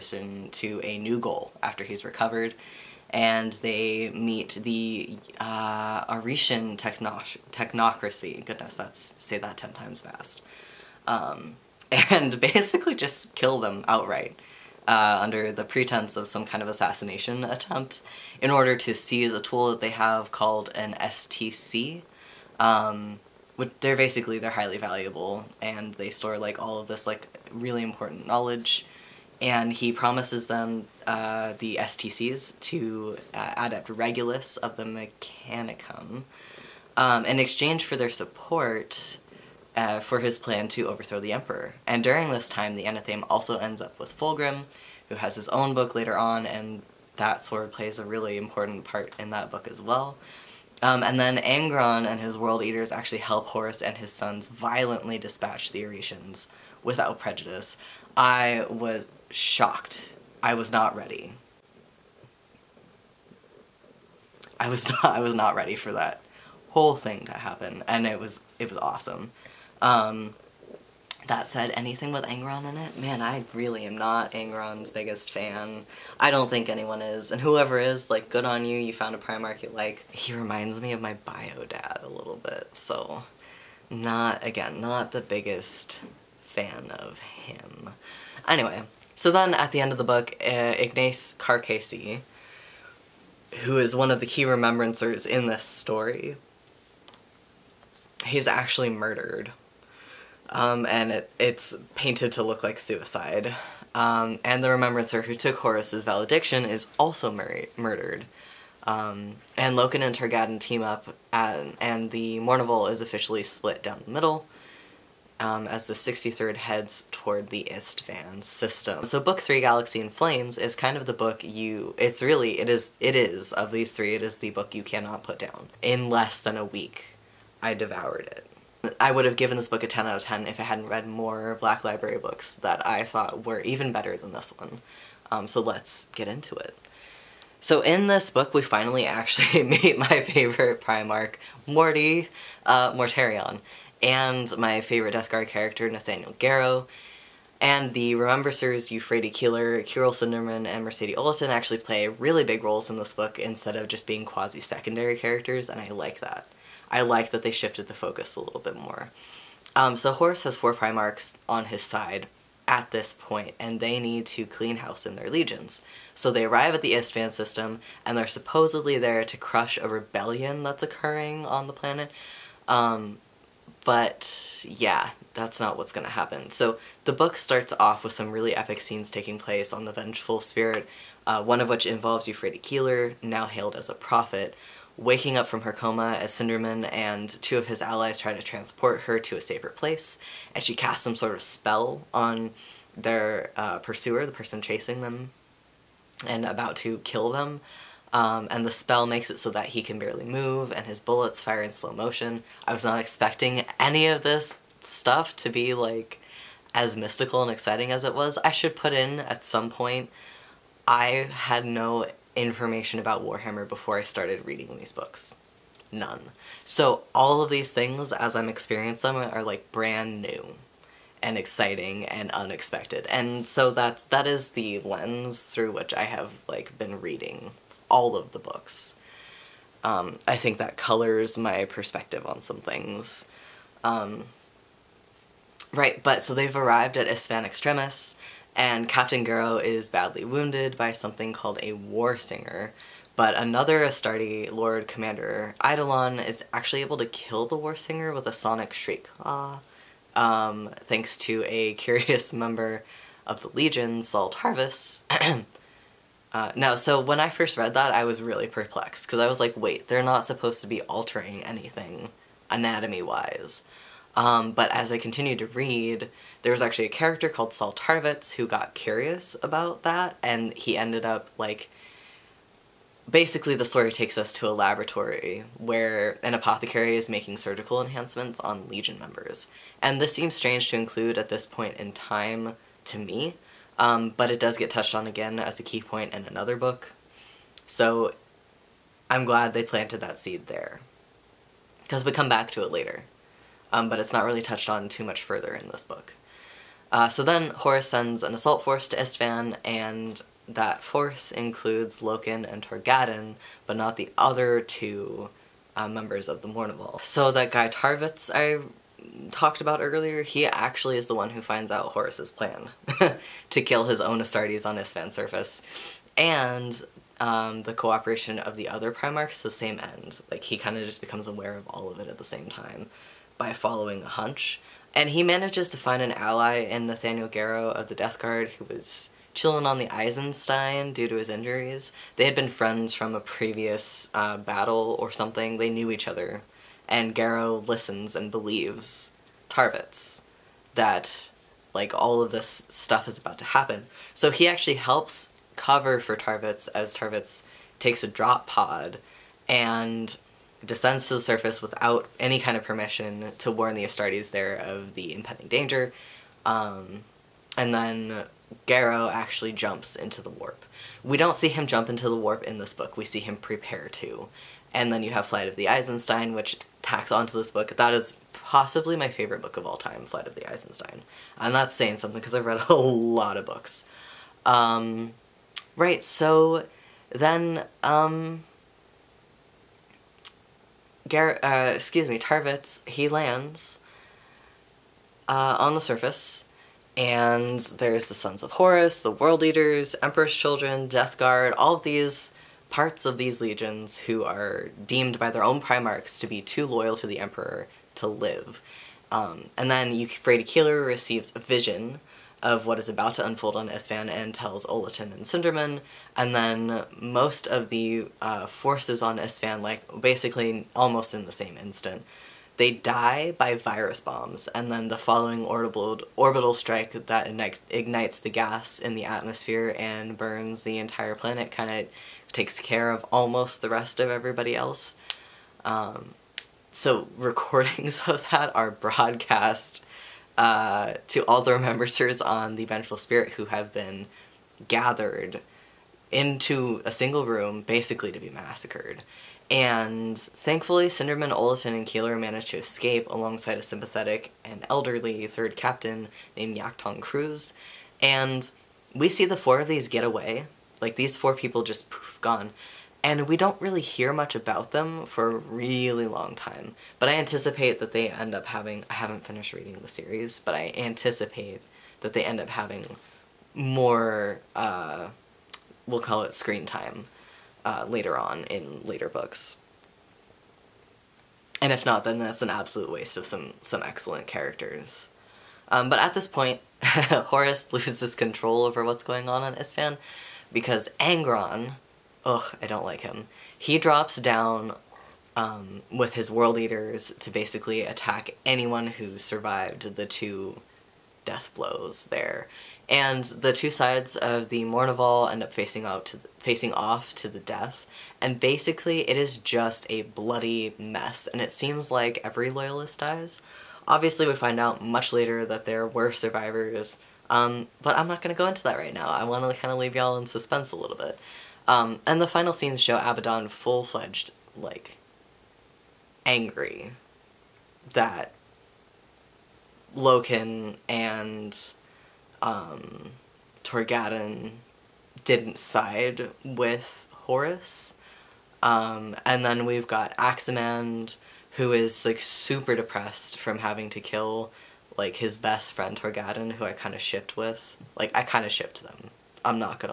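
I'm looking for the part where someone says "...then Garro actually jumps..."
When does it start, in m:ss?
5:57.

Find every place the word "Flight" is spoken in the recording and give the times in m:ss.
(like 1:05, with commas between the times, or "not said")
6:05, 6:10.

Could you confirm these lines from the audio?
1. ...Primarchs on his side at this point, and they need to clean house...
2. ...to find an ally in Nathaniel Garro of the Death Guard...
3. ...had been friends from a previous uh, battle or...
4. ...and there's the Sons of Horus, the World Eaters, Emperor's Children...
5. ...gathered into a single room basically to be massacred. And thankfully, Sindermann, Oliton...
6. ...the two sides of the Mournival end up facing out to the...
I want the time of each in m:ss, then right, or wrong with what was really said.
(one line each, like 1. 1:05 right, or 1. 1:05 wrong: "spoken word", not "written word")
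1. 2:40 right
2. 5:25 right
3. 5:32 right
4. 6:26 right
5. 7:14 right
6. 8:13 right.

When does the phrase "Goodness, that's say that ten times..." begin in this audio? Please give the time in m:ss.
0:08.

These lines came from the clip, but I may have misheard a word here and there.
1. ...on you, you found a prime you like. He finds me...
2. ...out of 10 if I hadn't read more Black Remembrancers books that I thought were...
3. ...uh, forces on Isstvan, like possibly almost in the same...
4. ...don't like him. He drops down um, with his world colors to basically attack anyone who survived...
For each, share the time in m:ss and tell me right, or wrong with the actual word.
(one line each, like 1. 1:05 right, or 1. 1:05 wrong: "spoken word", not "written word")
1. 1:18 wrong: "reminds", not "finds"
2. 2:10 wrong: "Library", not "Remembrancers"
3. 6:48 wrong: "basically", not "possibly"
4. 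8:02 wrong: "eaters", not "colors".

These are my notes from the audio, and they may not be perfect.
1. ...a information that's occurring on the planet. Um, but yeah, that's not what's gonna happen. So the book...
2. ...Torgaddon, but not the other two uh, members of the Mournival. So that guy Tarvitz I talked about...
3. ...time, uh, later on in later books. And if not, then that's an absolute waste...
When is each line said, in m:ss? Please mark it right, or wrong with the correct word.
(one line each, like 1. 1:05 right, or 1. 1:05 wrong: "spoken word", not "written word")
1. 2:49 wrong: "rebellion", not "information"
2. 5:02 right
3. 7:46 right.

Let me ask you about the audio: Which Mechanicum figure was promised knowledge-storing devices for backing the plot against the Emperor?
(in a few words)
Regulus.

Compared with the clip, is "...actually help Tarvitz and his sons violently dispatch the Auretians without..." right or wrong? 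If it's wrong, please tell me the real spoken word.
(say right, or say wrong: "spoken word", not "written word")
wrong: "Horus", not "Tarvitz".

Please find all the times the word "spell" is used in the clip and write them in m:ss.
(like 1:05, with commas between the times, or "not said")
3:11, 3:18.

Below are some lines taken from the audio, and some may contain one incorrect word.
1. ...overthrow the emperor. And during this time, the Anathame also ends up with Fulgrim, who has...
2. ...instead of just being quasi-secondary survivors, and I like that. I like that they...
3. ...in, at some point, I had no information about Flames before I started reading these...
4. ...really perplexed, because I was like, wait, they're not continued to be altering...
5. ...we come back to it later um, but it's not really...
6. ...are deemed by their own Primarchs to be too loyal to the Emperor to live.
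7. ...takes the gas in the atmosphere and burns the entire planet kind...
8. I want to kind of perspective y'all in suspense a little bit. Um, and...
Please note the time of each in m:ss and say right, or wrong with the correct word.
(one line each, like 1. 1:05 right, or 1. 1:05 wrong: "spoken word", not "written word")
1. 0:40 right
2. 2:33 wrong: "characters", not "survivors"
3. 3:28 wrong: "Warhammer", not "Flames"
4. 4:18 wrong: "supposed", not "continued"
5. 4:52 right
6. 6:34 right
7. 6:57 wrong: "ignites", not "takes"
8. 8:29 wrong: "leave", not "perspective".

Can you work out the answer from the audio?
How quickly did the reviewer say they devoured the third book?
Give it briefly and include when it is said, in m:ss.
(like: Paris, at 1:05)
less than a week, at 2:06.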